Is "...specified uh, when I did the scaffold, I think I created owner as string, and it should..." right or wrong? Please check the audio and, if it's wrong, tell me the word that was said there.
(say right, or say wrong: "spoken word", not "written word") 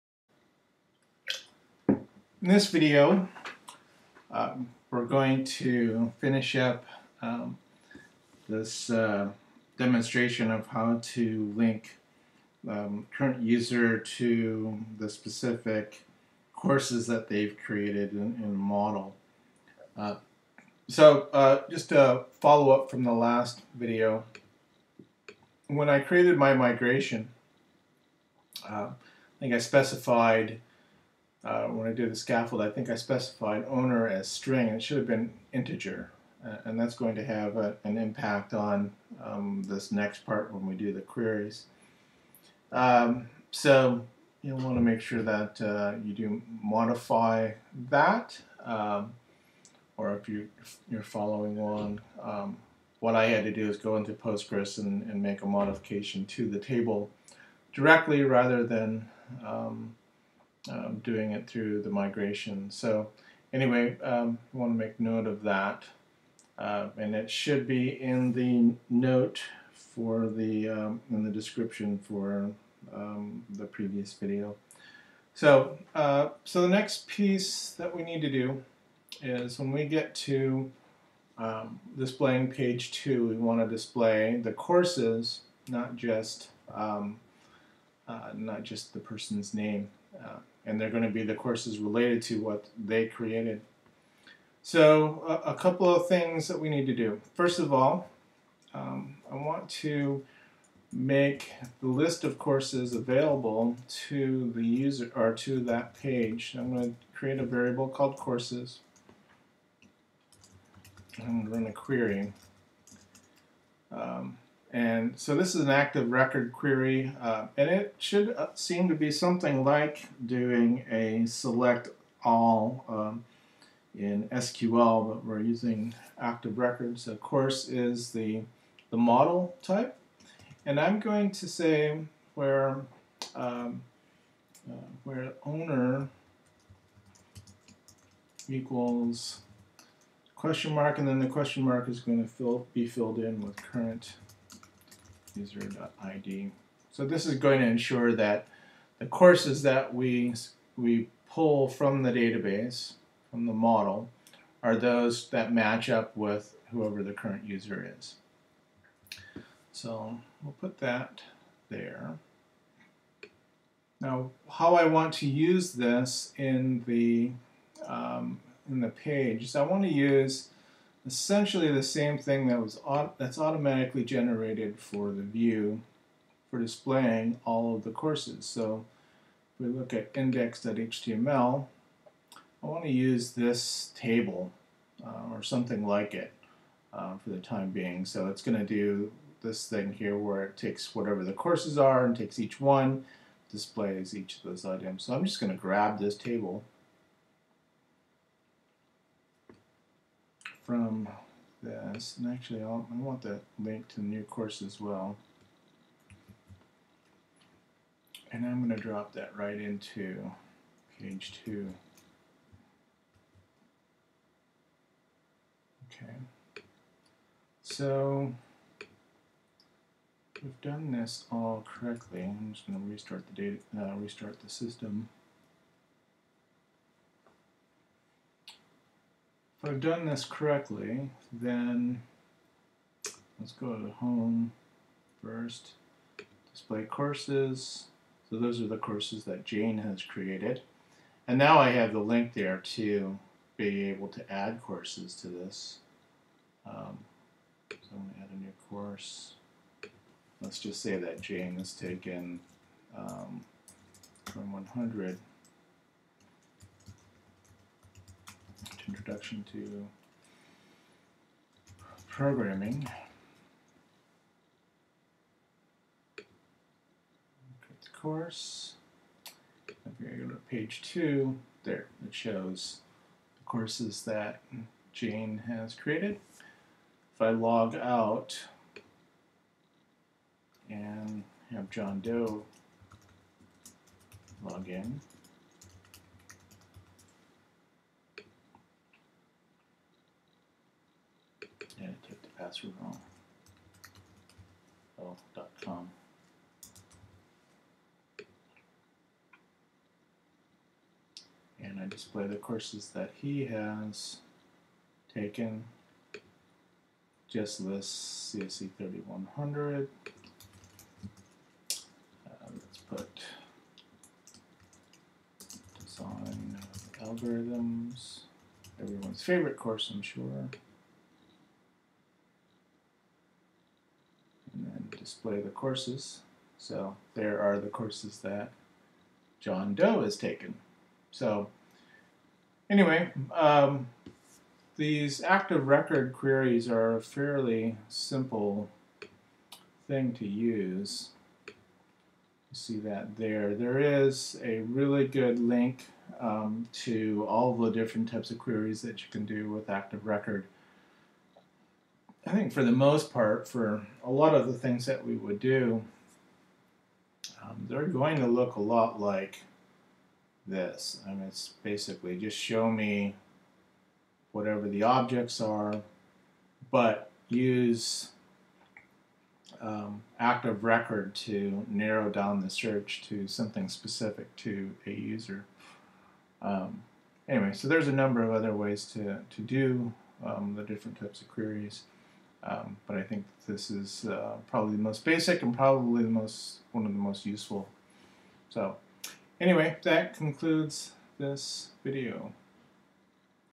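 wrong: "specified", not "created".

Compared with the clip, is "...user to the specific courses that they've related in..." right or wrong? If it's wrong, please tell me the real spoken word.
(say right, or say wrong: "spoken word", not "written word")
wrong: "created", not "related".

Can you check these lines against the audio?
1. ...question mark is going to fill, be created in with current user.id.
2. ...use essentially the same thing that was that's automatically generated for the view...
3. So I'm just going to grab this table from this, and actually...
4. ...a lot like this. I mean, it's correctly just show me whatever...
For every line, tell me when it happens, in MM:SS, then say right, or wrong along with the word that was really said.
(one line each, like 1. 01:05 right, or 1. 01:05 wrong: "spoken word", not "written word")
1. 02:21 wrong: "filled", not "created"
2. 02:49 right
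3. 03:15 right
4. 05:58 wrong: "basically", not "correctly".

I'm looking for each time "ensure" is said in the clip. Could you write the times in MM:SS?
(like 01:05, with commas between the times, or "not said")
02:27.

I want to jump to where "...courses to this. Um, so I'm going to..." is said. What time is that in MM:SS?
04:04.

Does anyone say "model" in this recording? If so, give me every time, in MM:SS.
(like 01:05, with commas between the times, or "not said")
00:18, 02:08, 02:33.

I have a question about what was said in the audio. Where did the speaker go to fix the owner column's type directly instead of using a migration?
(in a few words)
Postgres.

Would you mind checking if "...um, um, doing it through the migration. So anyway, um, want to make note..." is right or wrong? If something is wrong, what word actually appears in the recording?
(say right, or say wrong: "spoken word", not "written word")
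right.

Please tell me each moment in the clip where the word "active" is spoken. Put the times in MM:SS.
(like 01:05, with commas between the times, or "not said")
01:55, 02:06, 05:35, 05:49, 06:10.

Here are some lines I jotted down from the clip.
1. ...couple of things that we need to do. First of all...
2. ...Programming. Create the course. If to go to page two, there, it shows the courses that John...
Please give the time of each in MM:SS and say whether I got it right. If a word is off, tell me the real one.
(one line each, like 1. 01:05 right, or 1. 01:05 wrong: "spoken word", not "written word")
1. 01:35 right
2. 04:22 wrong: "Jane", not "John".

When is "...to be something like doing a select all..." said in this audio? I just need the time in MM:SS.
01:58.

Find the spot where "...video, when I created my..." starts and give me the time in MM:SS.
00:23.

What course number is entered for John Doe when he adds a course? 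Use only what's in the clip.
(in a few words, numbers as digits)
CSC 3100.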